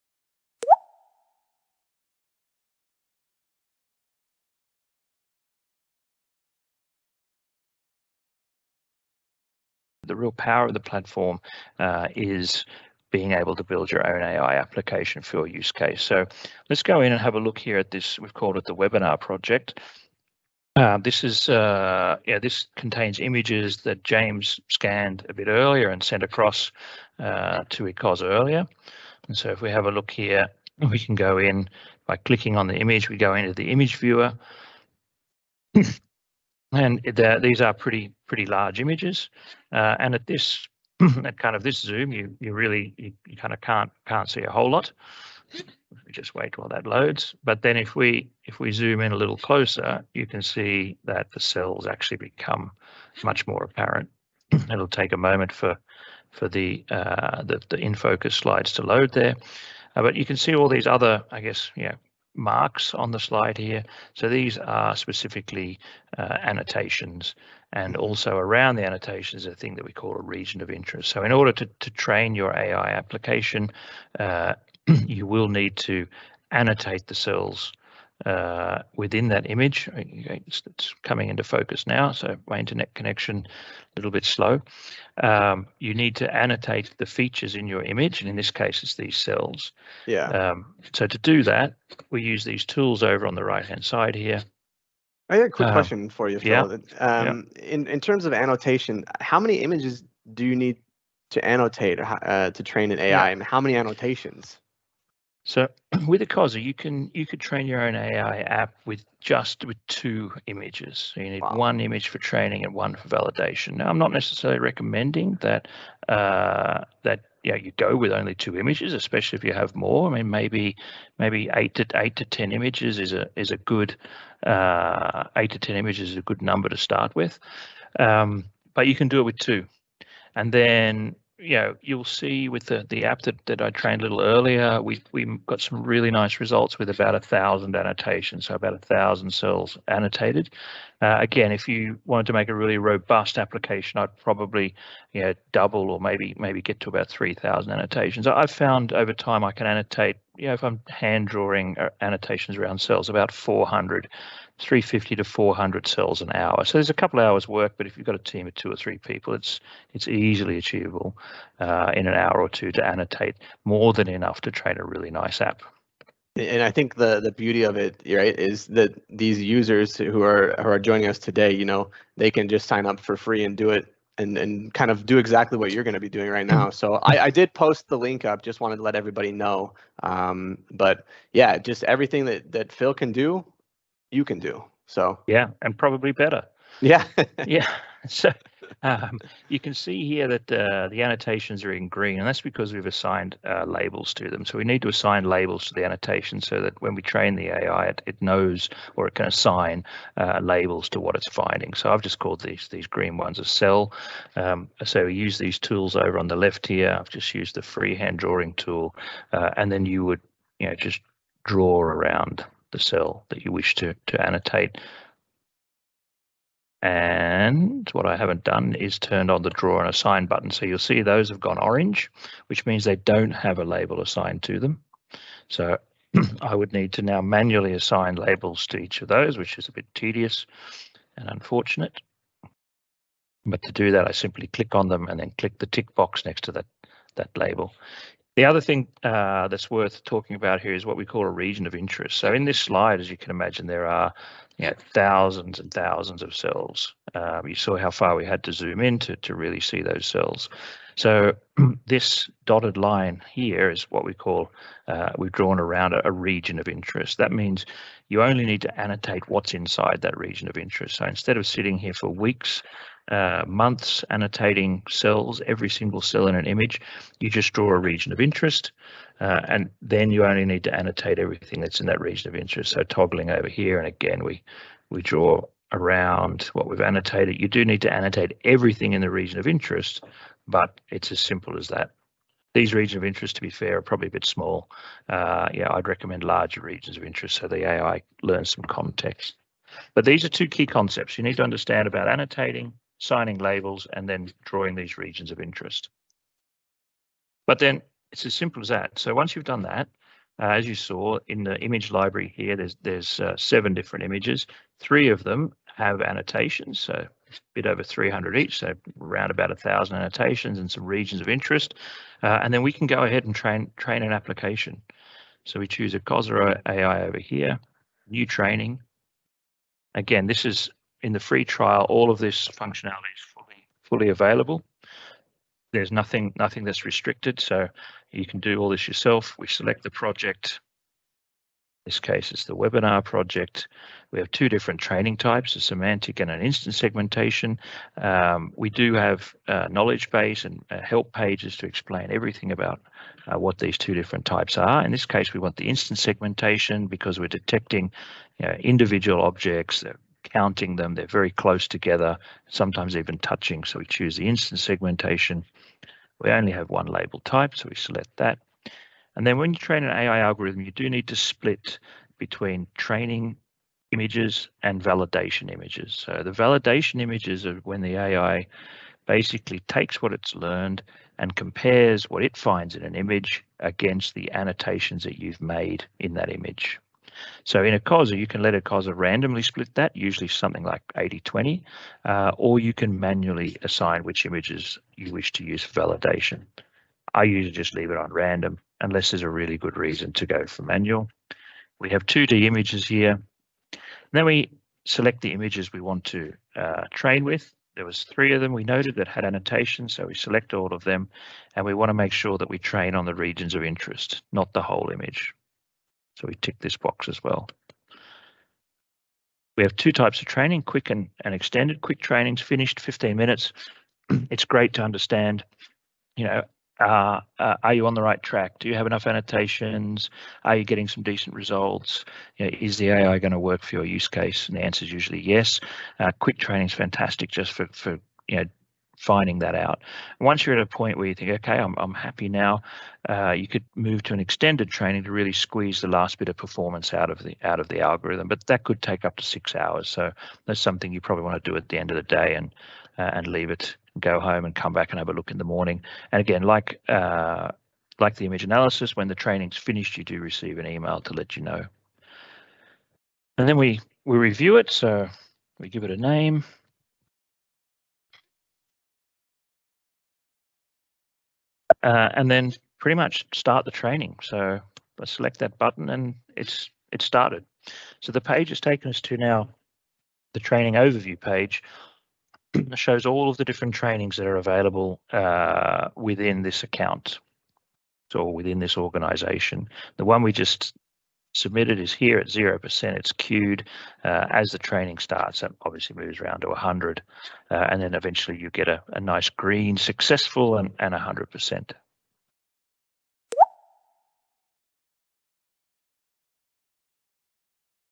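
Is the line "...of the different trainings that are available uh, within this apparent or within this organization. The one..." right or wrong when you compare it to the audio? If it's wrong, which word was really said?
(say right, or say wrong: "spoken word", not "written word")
wrong: "account", not "apparent".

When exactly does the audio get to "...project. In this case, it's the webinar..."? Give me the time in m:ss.
5:29.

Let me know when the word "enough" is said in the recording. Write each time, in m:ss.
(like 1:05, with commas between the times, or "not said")
2:44, 6:58.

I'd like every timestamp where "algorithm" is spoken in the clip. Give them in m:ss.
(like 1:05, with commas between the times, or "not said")
6:00, 7:17.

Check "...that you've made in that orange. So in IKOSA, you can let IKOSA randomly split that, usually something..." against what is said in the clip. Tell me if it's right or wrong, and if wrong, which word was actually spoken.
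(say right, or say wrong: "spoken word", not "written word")
wrong: "image", not "orange".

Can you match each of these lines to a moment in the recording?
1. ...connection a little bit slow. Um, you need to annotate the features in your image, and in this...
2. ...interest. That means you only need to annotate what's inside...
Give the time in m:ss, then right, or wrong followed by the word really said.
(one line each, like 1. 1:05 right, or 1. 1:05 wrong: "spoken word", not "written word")
1. 1:22 right
2. 4:16 right.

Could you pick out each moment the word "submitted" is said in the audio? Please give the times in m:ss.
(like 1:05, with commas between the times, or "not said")
8:01.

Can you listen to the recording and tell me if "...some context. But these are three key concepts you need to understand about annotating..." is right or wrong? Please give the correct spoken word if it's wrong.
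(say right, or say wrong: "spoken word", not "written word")
wrong: "two", not "three".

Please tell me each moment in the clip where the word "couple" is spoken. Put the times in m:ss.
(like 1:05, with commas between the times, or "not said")
2:36.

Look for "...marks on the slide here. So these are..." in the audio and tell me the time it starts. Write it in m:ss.
1:02.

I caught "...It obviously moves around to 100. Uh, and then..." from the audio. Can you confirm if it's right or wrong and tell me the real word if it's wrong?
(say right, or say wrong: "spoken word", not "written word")
right.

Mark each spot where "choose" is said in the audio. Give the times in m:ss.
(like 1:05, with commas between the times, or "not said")
5:15, 5:53.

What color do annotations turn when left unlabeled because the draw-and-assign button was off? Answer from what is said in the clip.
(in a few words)
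orange.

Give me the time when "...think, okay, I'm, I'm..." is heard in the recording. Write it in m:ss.
7:11.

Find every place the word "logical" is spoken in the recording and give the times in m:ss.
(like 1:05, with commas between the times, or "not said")
not said.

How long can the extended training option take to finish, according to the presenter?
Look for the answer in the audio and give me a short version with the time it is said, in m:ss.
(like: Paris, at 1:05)
6 hours, at 7:19.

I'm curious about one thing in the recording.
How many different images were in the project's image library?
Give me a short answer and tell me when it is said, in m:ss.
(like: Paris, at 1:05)
7, at 5:03.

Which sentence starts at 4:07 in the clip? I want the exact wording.
Um, you saw how far we had to zoom in to, to really see those cells.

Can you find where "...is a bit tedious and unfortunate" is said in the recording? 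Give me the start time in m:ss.
3:49.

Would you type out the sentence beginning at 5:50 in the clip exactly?
They're very close together, sometimes even touching.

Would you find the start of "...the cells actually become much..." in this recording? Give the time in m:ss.
0:51.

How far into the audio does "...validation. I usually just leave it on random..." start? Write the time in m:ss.
6:25.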